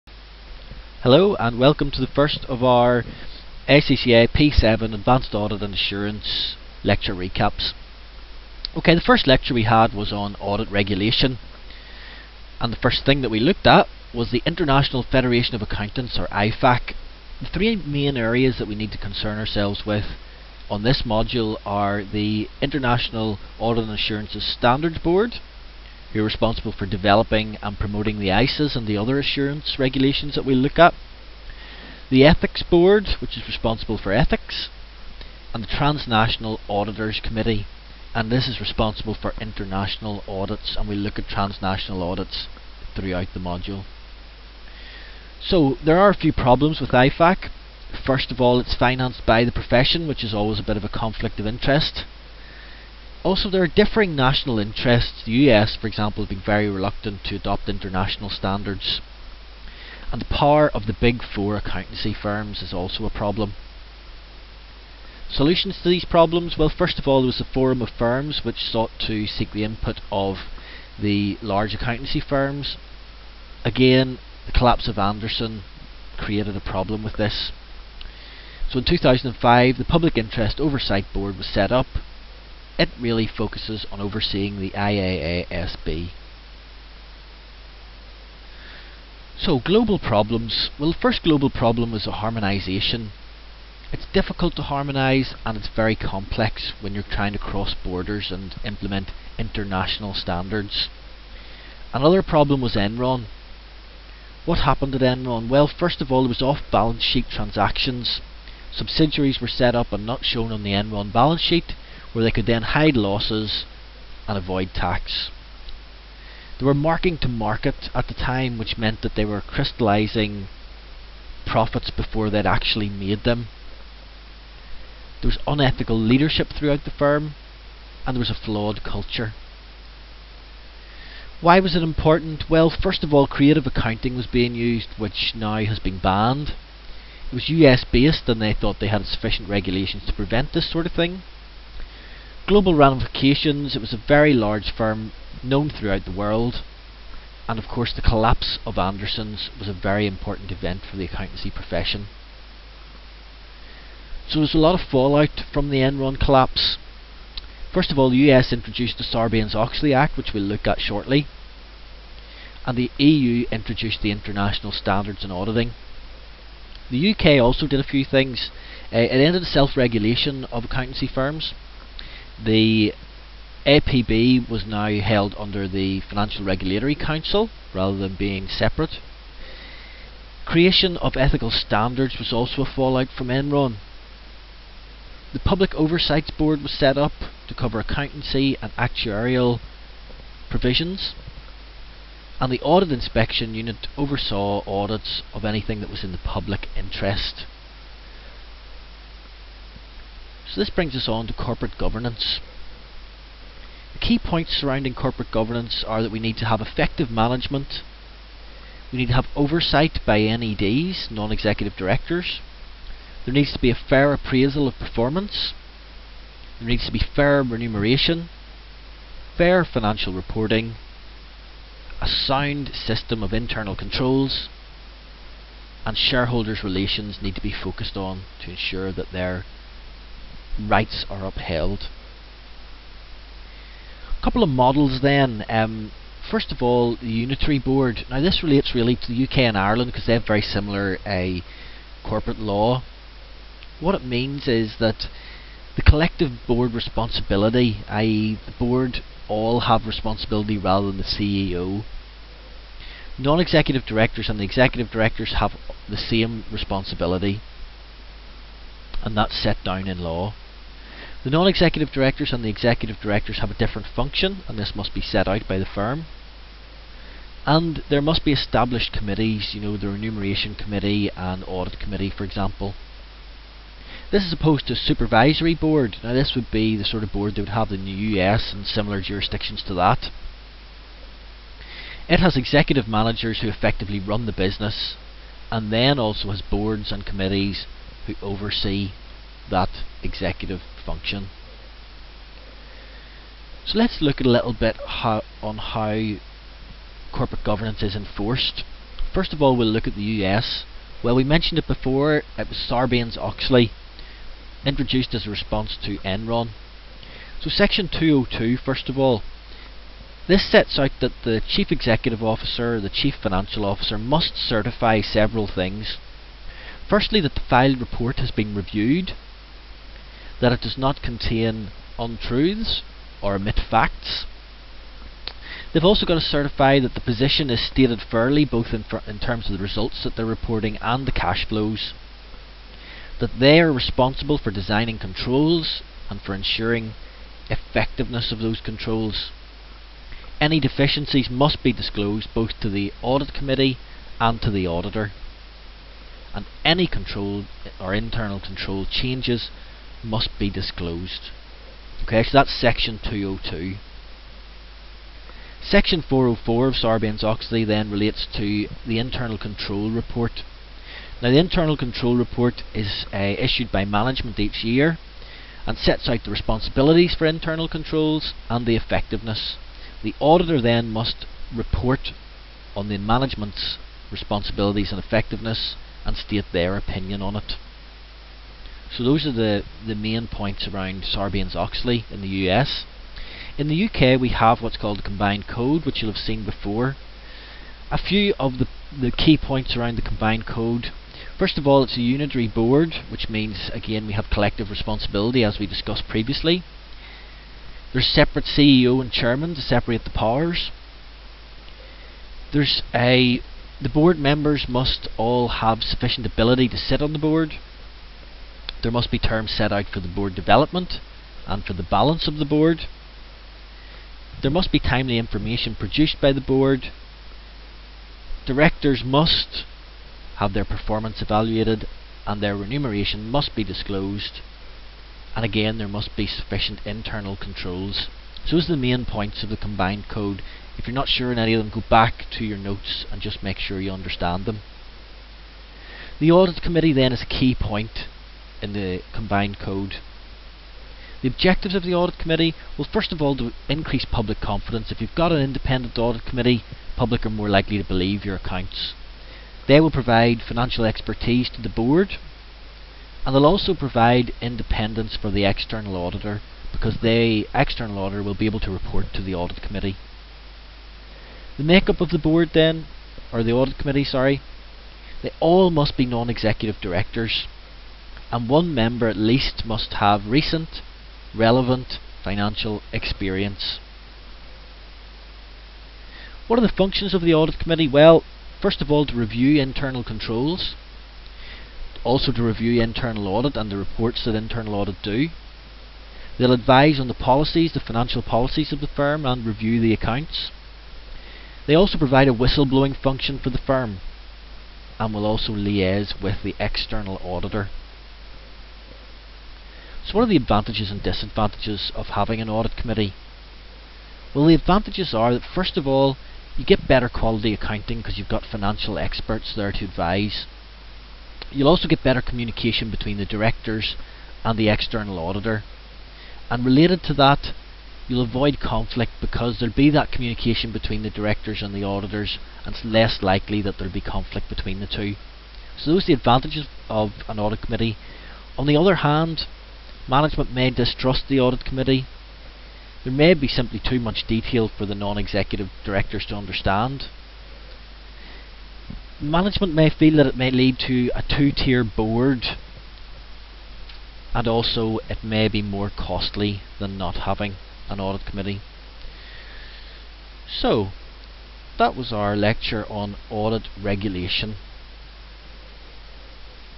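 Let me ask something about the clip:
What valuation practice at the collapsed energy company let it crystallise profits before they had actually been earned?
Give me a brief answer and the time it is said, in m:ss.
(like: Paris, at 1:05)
Marking to market, at 1:56.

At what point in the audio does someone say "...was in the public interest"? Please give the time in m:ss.
3:15.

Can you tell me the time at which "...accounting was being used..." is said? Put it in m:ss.
2:13.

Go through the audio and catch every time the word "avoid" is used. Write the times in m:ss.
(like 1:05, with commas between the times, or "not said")
1:54, 8:38.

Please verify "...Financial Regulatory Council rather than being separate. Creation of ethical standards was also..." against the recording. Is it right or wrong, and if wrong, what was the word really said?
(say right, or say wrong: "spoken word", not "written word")
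right.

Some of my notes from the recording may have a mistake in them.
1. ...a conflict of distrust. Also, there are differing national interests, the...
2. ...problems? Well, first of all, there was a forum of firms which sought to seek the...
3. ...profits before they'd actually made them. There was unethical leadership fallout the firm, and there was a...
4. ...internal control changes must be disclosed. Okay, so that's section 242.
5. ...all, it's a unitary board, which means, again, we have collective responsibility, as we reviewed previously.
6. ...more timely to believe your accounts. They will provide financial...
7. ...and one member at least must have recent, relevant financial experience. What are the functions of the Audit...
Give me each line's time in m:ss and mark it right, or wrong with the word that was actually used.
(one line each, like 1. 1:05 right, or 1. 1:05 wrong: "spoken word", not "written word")
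1. 0:50 wrong: "interest", not "distrust"
2. 1:06 right
3. 2:01 wrong: "throughout", not "fallout"
4. 5:47 wrong: "202", not "242"
5. 6:31 wrong: "discussed", not "reviewed"
6. 7:27 wrong: "likely", not "timely"
7. 7:48 right.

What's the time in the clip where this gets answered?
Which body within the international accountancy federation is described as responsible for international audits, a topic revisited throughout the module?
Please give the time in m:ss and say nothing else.
0:35.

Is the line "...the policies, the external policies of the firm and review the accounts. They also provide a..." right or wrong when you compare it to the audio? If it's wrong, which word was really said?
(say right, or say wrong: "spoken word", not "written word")
wrong: "financial", not "external".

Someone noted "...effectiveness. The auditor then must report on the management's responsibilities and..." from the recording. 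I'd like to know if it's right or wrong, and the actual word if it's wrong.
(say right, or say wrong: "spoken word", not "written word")
right.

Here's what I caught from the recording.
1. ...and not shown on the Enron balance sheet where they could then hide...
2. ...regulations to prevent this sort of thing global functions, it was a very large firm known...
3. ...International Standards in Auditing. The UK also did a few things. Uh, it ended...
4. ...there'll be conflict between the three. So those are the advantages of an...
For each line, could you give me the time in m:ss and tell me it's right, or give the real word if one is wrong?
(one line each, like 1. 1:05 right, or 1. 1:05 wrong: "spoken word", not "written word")
1. 1:49 right
2. 2:19 wrong: "ramifications", not "functions"
3. 2:44 right
4. 8:43 wrong: "two", not "three".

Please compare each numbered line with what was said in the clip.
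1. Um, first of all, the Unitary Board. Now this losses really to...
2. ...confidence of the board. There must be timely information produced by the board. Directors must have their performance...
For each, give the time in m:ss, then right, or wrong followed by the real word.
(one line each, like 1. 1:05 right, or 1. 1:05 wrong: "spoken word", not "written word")
1. 3:55 wrong: "relates", not "losses"
2. 6:51 wrong: "balance", not "confidence".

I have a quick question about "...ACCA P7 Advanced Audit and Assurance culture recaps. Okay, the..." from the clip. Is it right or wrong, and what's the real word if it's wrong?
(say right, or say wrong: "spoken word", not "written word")
wrong: "lecture", not "culture".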